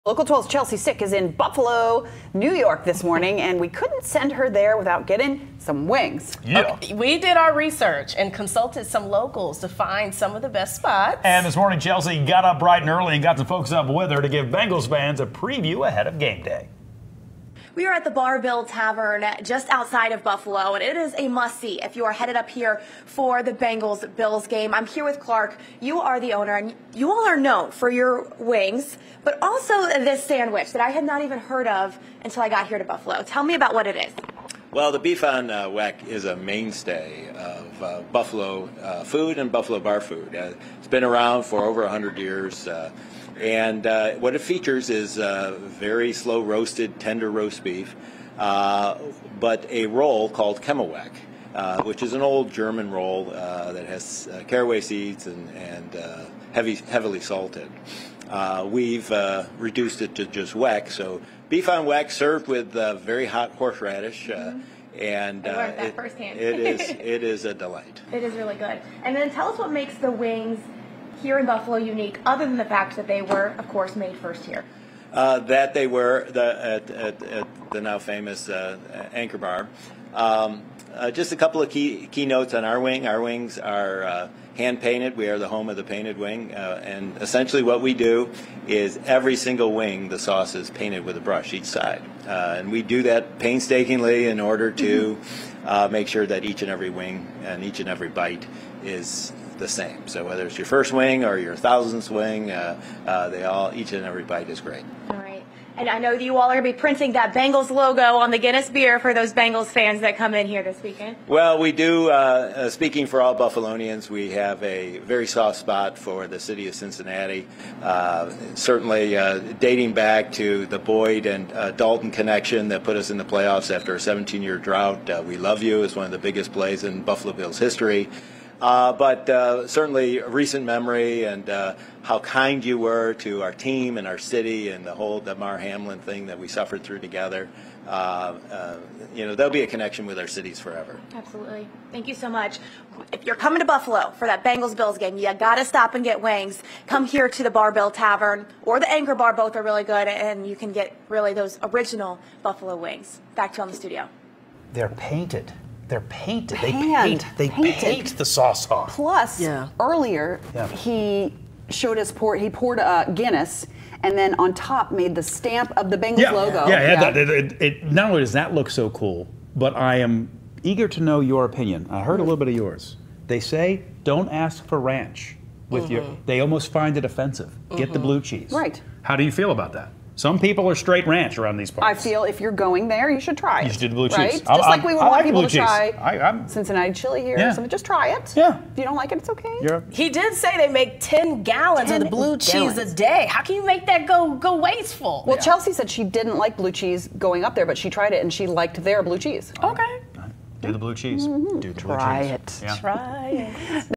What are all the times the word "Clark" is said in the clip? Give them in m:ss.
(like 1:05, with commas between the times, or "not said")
0:25.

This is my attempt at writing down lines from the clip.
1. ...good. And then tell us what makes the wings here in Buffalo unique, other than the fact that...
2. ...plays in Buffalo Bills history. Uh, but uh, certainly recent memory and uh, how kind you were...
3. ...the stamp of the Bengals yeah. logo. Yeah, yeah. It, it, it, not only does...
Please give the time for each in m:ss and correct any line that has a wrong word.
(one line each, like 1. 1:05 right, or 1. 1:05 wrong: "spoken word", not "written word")
1. 1:08 right
2. 2:06 right
3. 2:45 right.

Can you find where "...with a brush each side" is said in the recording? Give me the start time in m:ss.
1:31.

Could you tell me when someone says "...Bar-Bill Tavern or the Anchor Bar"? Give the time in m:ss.
2:27.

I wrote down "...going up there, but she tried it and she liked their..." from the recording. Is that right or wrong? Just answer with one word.
right.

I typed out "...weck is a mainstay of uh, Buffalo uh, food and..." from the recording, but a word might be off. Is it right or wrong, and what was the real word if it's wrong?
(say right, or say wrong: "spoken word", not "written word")
right.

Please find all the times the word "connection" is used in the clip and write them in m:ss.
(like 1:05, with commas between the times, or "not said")
2:02, 2:19.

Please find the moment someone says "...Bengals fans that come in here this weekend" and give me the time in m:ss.
1:49.